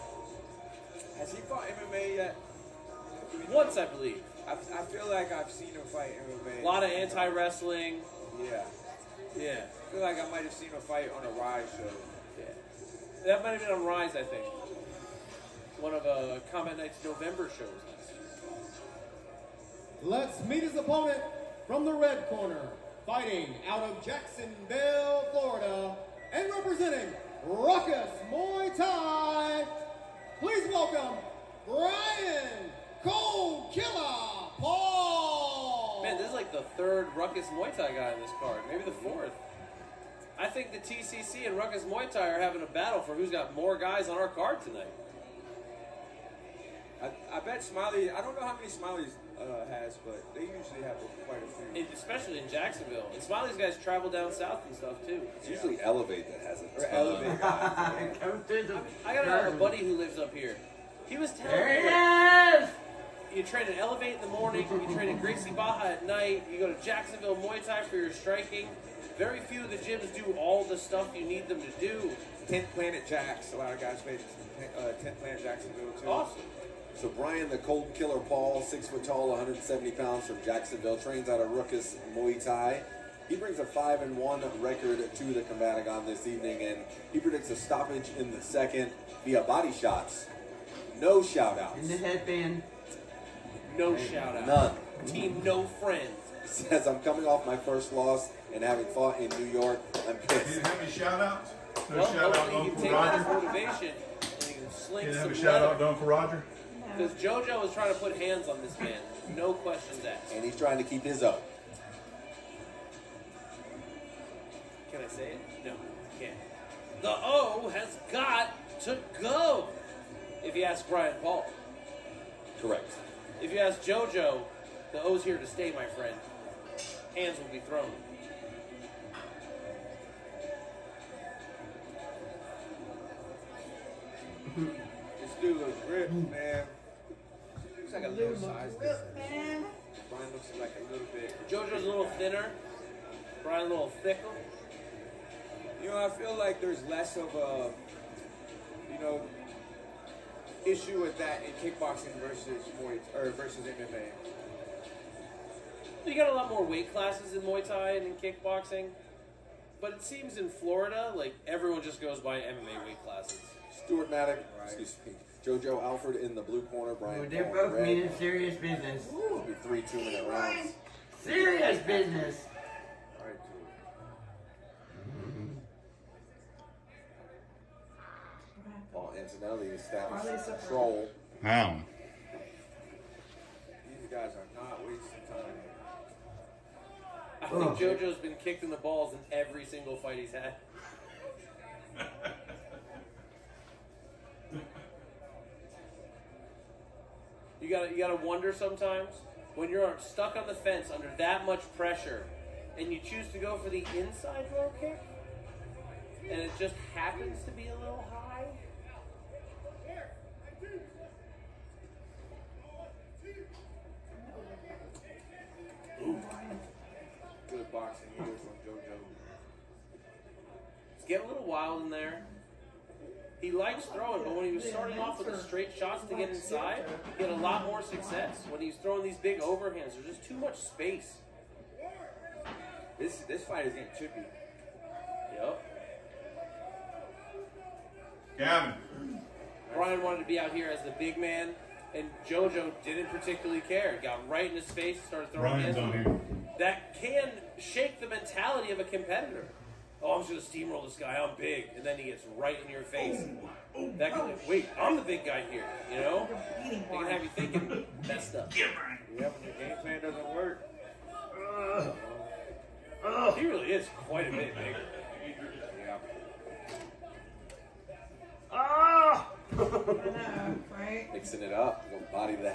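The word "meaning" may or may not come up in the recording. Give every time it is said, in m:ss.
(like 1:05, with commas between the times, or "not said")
2:47.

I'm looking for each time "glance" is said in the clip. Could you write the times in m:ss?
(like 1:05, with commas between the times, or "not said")
not said.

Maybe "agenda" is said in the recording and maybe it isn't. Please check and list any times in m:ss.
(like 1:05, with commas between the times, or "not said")
not said.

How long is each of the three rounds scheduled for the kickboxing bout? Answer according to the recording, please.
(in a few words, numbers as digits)
2 minutes.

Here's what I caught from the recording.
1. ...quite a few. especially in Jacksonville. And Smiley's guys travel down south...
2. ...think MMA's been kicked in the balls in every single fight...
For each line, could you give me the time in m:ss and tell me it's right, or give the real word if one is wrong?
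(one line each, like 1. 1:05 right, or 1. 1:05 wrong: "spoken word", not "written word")
1. 0:51 right
2. 3:07 wrong: "JoJo", not "MMA".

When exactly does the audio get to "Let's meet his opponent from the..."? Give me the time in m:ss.
0:20.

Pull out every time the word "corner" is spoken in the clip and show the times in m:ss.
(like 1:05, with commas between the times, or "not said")
0:22, 2:46.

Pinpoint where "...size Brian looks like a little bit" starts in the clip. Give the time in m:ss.
2:18.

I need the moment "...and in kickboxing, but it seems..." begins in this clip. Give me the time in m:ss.
2:37.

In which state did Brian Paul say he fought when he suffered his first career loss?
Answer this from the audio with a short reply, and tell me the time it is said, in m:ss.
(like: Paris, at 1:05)
New York, at 1:39.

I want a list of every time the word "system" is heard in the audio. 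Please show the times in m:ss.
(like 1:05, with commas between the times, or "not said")
not said.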